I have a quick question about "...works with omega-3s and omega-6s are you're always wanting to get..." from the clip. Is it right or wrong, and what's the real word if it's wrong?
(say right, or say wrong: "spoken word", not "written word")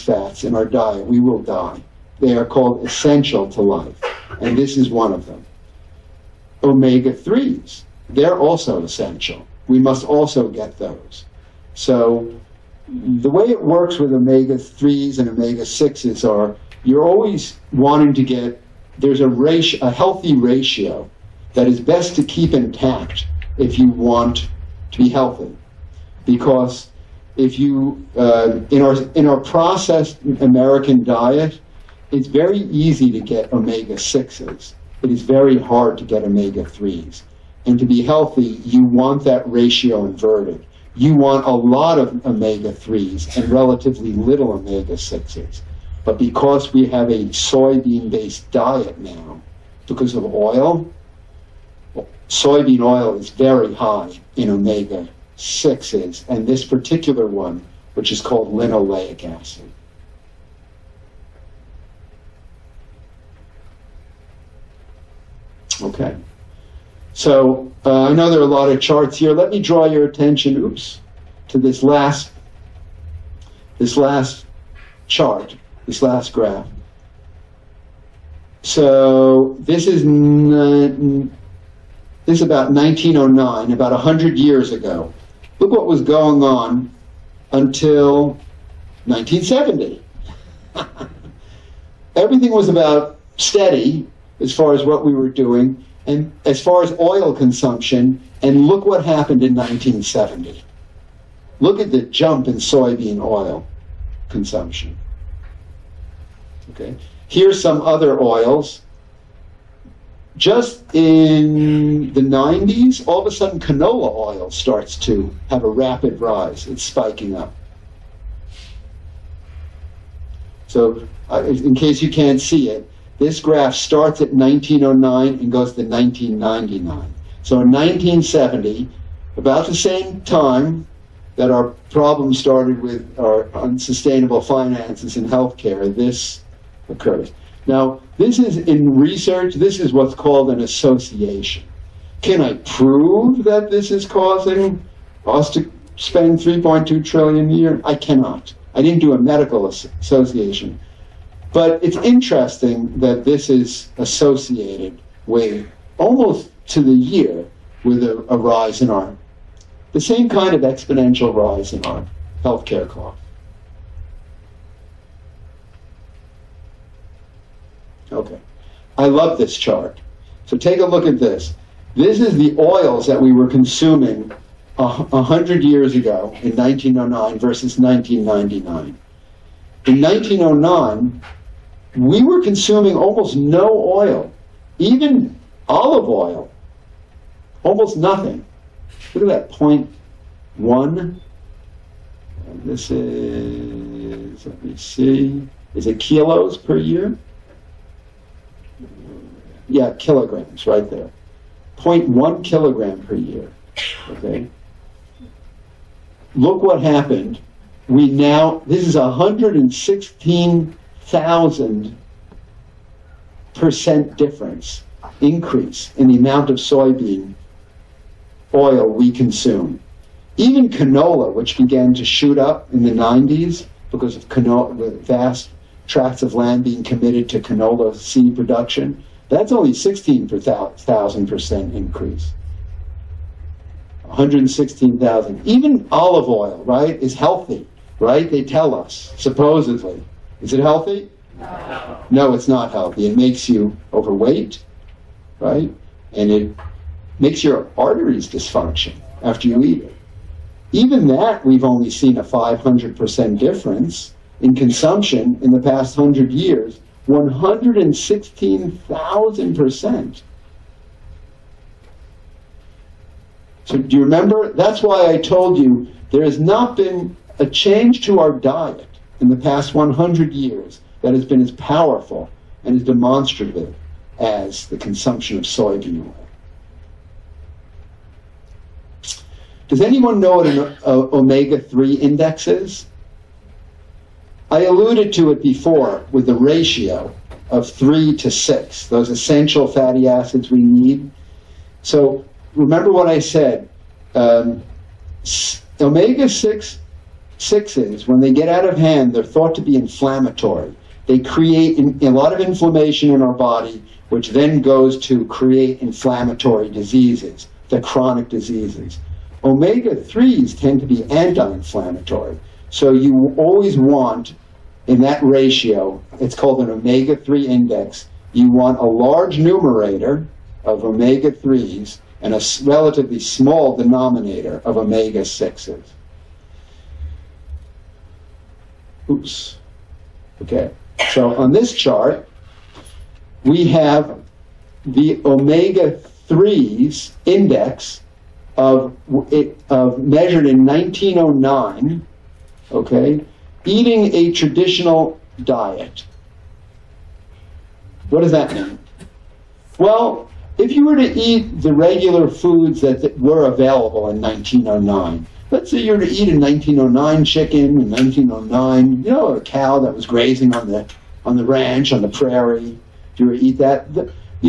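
right.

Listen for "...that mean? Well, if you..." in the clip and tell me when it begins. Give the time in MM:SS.
05:48.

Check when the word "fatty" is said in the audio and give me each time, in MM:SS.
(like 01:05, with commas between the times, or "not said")
04:49.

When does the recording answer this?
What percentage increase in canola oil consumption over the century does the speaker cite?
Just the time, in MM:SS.
03:49.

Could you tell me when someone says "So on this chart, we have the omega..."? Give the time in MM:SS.
05:31.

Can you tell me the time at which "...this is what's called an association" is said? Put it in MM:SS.
02:19.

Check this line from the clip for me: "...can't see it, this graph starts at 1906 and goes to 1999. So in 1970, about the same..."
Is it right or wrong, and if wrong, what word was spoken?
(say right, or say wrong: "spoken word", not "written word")
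wrong: "1909", not "1906".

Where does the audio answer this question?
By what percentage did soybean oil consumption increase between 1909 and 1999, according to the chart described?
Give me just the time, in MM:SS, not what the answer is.
03:28.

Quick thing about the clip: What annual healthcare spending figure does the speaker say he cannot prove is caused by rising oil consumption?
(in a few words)
3.2 trillion.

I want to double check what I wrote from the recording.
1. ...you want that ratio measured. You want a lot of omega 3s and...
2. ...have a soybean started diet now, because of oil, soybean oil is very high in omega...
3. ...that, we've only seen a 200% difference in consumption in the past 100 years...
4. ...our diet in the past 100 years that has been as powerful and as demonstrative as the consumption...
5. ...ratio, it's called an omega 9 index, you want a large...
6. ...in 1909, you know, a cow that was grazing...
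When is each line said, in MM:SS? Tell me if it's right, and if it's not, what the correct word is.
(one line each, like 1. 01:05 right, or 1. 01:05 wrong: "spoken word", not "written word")
1. 00:38 wrong: "inverted", not "measured"
2. 00:46 wrong: "based", not "started"
3. 04:11 wrong: "500", not "200"
4. 04:28 right
5. 05:15 wrong: "3", not "9"
6. 05:57 right.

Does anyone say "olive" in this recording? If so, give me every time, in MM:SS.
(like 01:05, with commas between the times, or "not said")
03:05, 03:55.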